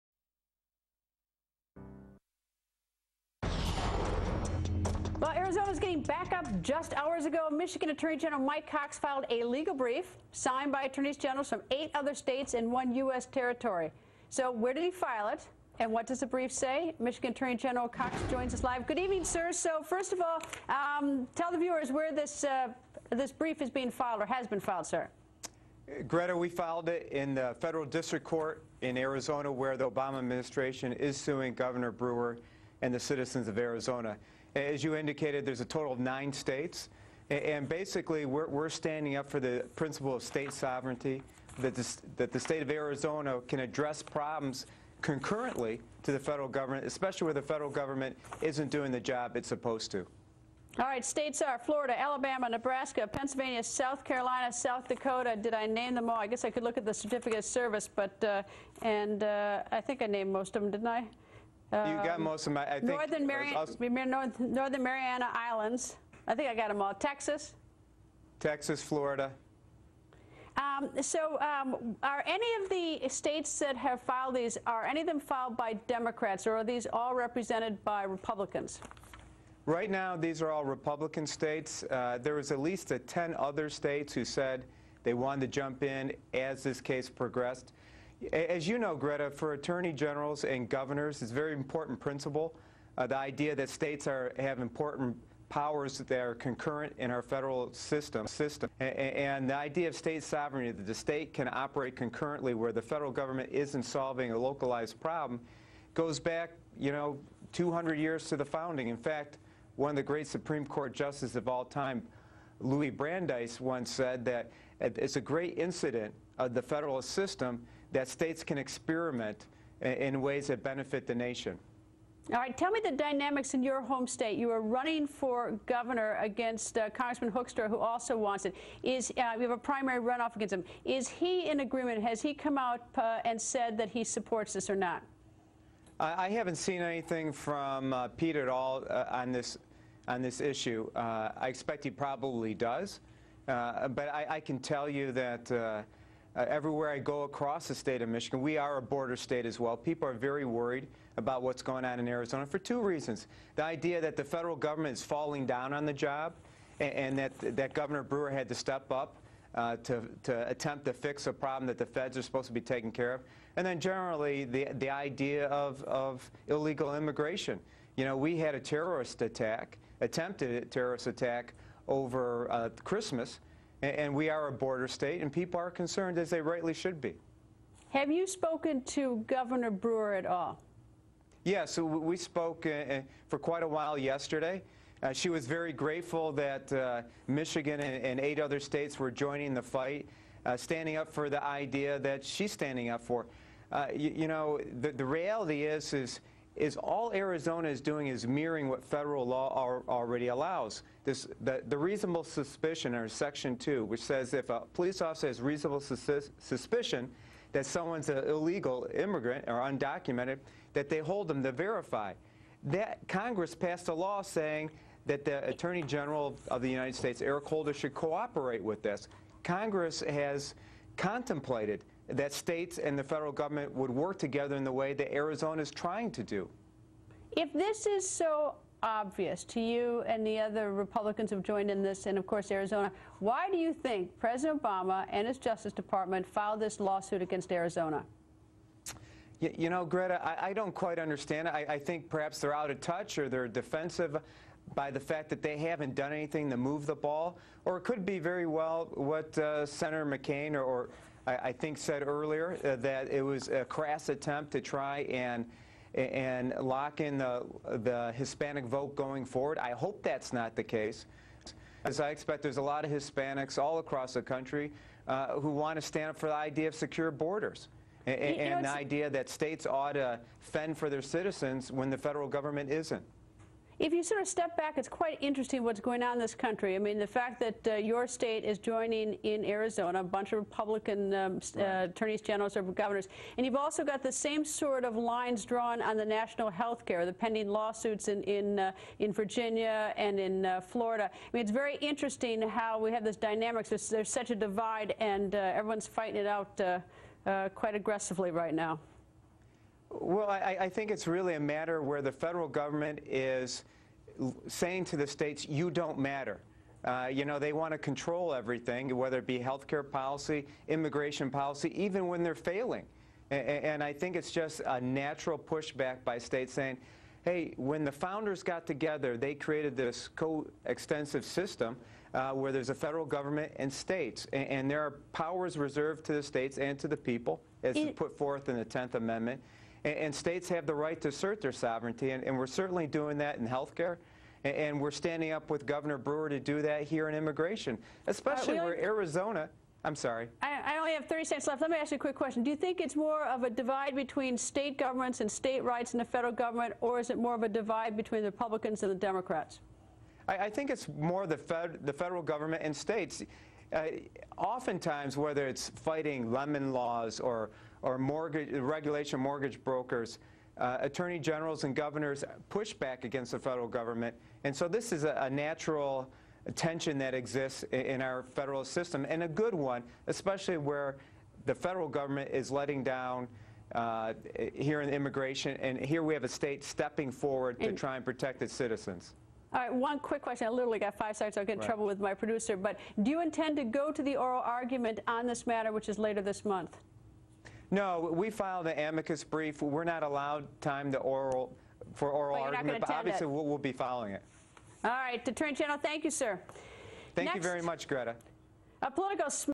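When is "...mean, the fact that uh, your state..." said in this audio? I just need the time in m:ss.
4:36.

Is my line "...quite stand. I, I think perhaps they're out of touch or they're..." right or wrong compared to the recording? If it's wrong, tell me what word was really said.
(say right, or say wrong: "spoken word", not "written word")
wrong: "understand", not "stand".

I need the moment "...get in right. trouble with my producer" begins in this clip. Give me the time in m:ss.
6:21.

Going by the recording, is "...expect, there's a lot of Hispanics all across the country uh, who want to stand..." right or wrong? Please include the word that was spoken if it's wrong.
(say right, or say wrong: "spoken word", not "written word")
right.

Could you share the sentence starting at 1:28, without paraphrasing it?
As you know, Greta, for attorney generals and governors, it's a very important principle.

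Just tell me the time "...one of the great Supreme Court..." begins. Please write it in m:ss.
1:49.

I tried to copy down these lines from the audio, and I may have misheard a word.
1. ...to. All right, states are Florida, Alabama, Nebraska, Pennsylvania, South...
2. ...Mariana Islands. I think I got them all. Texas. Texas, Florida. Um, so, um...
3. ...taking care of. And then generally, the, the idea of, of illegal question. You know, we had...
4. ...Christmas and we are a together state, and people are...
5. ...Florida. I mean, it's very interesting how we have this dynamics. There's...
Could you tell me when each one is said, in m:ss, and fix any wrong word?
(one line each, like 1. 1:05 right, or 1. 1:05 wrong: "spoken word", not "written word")
1. 0:49 right
2. 1:04 right
3. 2:42 wrong: "immigration", not "question"
4. 2:52 wrong: "border", not "together"
5. 4:50 right.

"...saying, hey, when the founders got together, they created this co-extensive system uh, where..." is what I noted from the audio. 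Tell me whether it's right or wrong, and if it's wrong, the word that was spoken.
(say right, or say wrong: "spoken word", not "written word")
right.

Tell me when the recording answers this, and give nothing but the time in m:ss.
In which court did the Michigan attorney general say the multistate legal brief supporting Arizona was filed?
0:27.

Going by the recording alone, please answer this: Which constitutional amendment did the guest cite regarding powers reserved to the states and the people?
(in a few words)
10th Amendment.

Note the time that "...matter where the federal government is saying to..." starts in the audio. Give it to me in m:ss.
5:01.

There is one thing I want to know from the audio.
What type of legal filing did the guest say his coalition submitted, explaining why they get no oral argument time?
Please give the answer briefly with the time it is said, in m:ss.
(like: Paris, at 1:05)
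Amicus brief, at 6:28.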